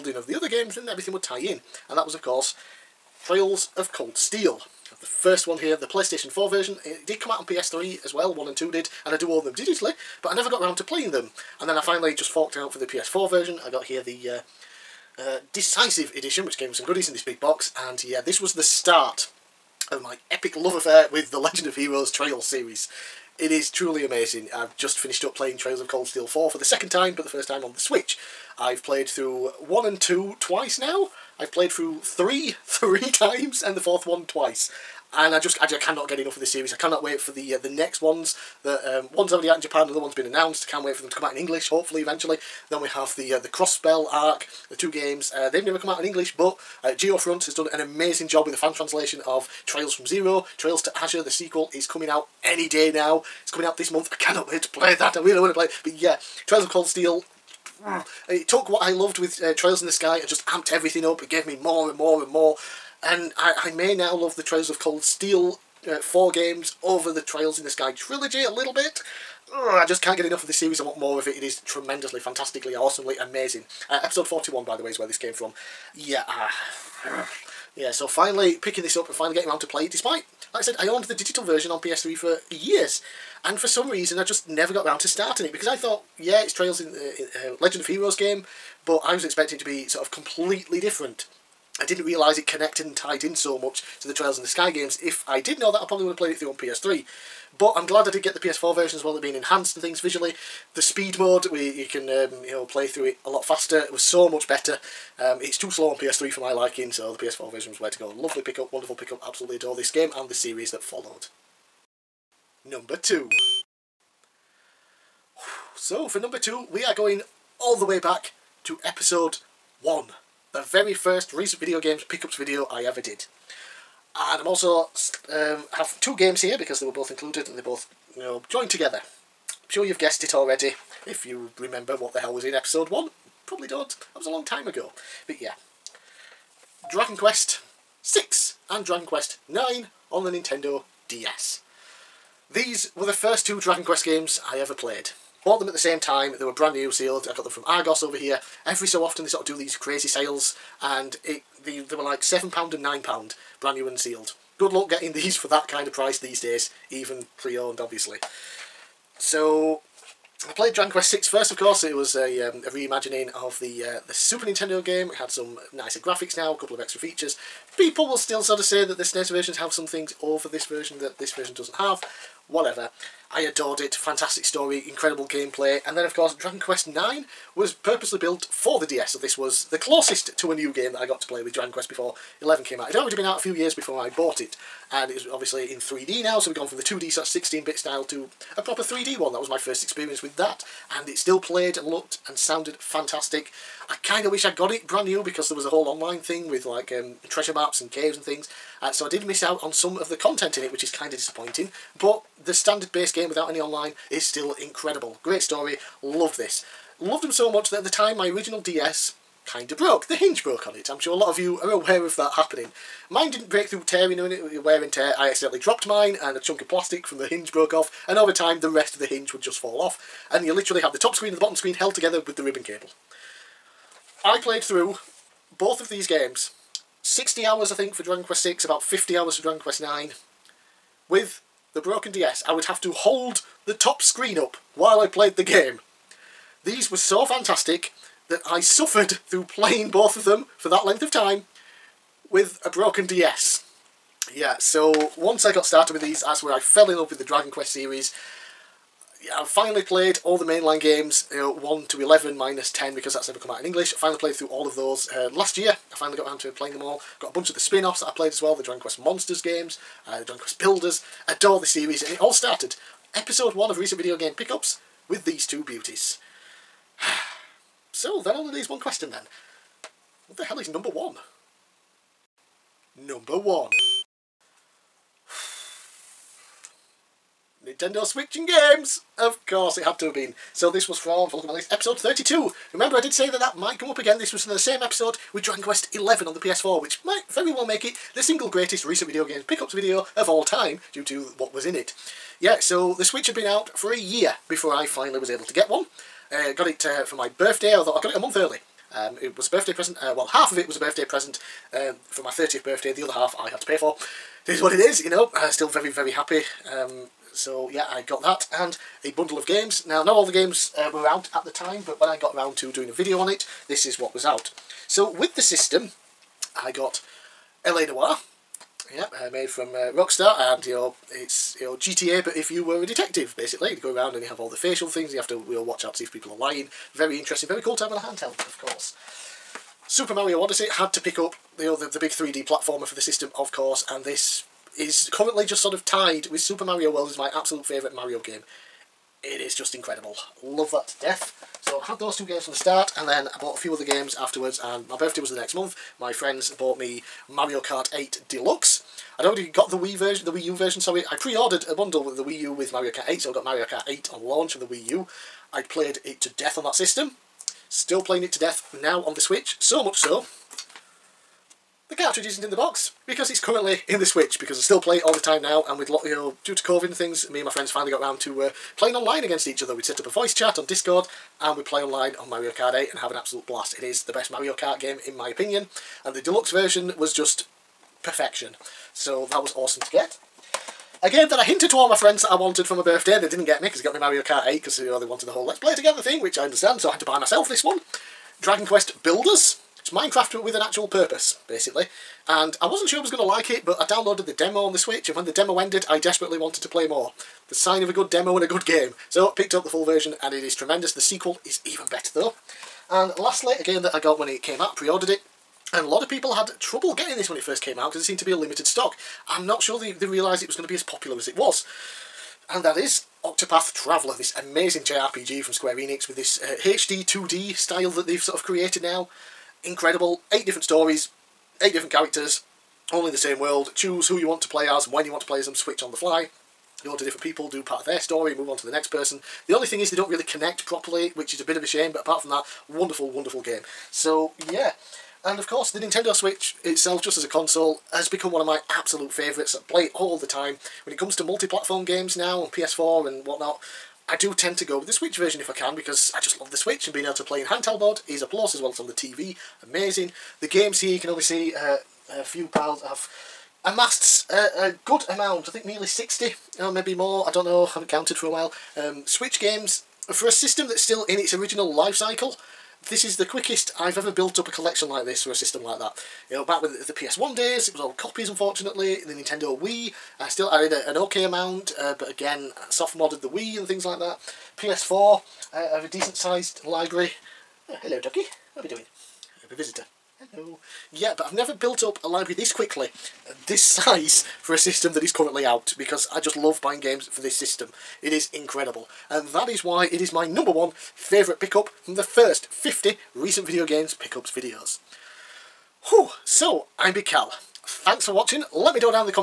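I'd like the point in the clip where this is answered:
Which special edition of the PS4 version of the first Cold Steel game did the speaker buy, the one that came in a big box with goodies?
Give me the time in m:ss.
0:15.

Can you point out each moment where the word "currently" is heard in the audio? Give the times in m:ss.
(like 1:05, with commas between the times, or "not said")
5:35, 6:03, 8:05.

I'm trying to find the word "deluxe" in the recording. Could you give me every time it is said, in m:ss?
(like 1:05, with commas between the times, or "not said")
5:48, 6:16.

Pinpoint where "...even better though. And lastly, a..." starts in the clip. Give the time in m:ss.
6:41.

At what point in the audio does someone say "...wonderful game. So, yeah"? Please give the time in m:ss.
7:13.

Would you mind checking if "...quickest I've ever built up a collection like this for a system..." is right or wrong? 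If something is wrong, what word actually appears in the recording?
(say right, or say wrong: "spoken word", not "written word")
right.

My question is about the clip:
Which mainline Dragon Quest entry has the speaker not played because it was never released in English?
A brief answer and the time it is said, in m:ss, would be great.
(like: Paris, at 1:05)
10, at 4:12.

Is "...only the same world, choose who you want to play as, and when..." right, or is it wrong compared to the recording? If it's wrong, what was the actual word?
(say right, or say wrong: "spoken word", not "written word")
right.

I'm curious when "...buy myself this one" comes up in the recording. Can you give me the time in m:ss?
6:27.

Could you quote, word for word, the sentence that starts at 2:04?
And I'm also um, have two games here because they were both included and they both you know joined together.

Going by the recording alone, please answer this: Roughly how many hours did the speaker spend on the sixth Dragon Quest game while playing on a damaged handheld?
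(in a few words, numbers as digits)
60 hours.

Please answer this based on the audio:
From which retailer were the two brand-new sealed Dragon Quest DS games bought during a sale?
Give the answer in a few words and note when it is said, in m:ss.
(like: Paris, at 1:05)
Argos, at 2:27.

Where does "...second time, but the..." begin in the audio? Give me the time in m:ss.
0:26.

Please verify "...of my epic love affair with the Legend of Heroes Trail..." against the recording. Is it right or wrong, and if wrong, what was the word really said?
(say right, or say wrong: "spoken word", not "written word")
right.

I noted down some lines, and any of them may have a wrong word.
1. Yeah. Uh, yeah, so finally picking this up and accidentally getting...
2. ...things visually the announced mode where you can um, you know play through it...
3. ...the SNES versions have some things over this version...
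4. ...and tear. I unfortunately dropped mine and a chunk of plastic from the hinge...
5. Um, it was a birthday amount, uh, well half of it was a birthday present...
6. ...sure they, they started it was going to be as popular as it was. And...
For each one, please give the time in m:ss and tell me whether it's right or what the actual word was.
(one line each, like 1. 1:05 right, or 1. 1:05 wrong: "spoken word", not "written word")
1. 1:15 wrong: "finally", not "accidentally"
2. 1:39 wrong: "speed", not "announced"
3. 2:48 right
4. 3:34 wrong: "accidentally", not "unfortunately"
5. 4:58 wrong: "present", not "amount"
6. 6:49 wrong: "realised", not "started".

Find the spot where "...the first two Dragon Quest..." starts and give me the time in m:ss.
2:23.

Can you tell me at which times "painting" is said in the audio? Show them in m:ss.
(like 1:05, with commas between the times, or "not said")
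not said.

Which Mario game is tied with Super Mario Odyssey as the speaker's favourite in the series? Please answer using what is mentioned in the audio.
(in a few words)
Super Mario World.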